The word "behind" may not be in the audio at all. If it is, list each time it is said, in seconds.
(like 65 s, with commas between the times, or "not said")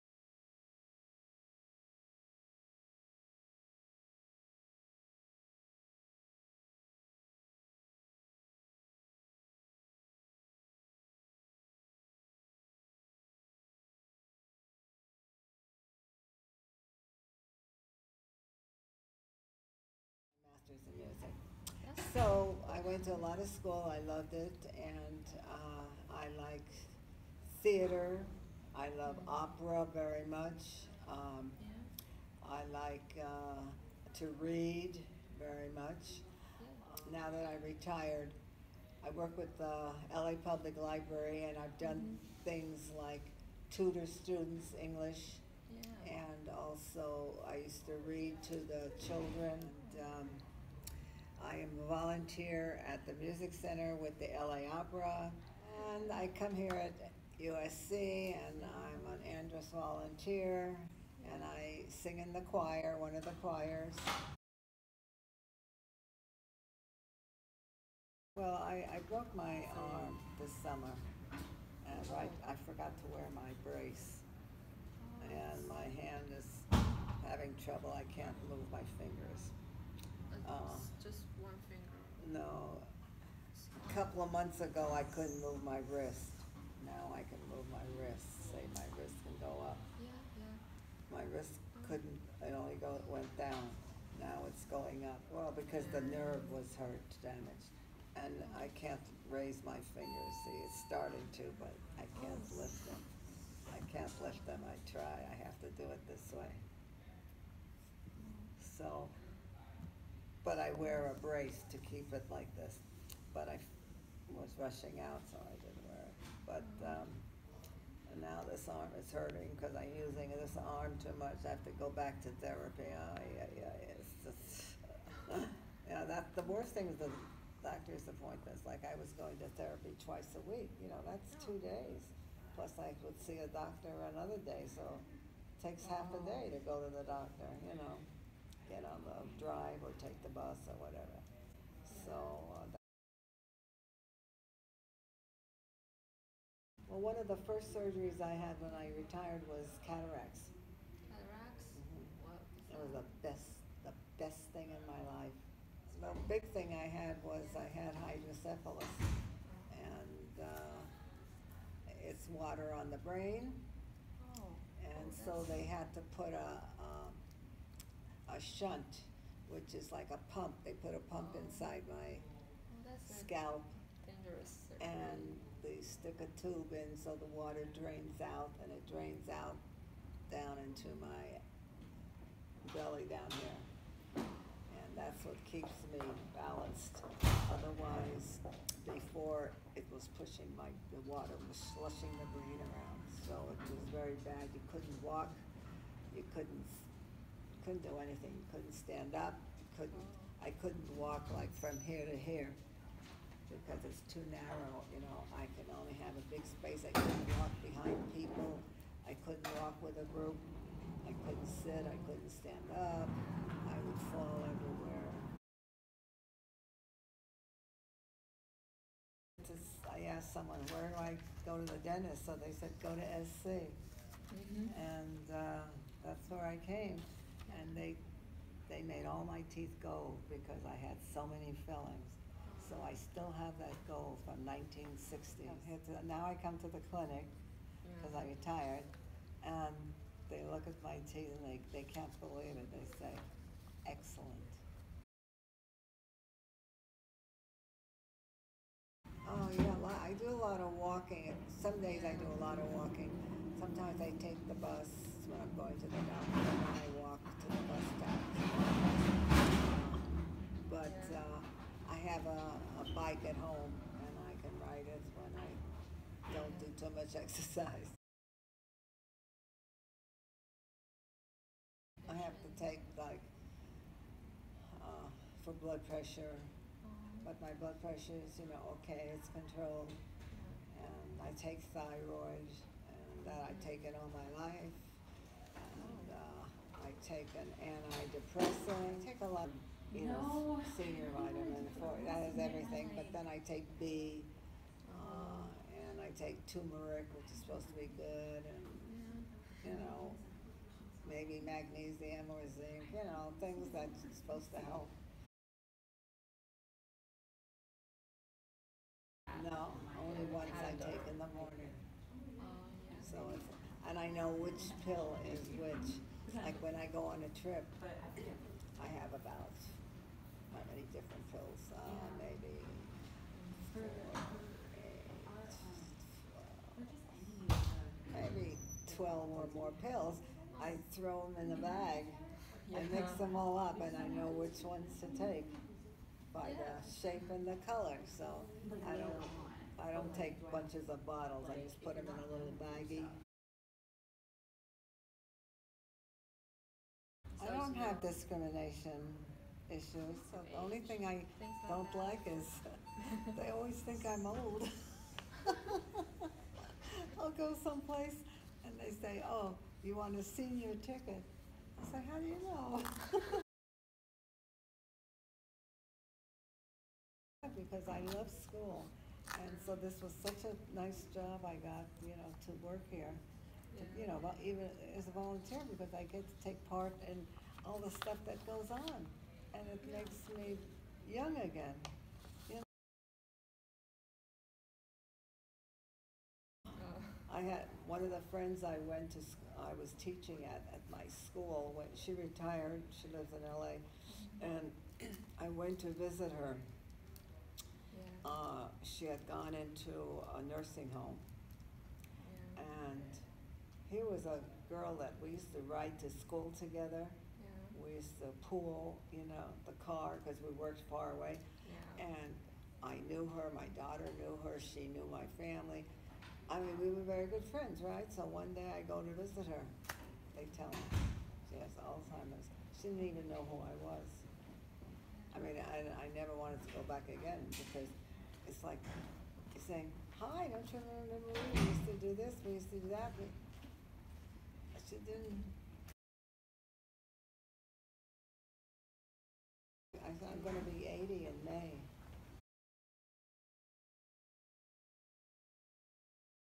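207 s.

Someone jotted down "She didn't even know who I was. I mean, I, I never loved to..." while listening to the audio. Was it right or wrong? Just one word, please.
wrong.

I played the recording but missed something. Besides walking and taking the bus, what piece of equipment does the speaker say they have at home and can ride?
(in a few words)
Bike.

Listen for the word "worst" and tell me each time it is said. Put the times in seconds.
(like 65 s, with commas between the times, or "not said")
126 s.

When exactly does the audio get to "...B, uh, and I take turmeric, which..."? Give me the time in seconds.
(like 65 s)
293 s.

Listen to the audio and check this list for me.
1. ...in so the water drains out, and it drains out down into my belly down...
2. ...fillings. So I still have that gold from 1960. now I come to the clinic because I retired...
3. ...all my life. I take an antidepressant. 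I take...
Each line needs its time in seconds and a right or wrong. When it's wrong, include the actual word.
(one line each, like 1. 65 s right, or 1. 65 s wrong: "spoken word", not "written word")
1. 176 s right
2. 231 s right
3. 283 s right.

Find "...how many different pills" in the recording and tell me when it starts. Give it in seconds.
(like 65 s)
320 s.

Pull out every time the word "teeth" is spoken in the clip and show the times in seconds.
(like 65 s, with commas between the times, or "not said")
229 s, 241 s.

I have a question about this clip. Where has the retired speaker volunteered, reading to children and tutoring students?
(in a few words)
LA Public Library.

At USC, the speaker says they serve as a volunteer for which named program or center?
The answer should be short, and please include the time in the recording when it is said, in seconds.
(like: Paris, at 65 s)
Andrus, at 59 s.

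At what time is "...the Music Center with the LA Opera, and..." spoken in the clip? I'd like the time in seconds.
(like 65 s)
53 s.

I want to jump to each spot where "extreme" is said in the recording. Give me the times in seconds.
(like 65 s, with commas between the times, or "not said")
not said.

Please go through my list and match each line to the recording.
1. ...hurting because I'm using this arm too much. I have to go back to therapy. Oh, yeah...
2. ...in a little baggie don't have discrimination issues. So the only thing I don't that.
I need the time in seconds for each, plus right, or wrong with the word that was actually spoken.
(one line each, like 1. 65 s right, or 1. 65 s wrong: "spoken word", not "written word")
1. 119 s right
2. 342 s right.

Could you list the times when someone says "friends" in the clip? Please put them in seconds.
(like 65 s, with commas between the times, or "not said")
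388 s, 417 s.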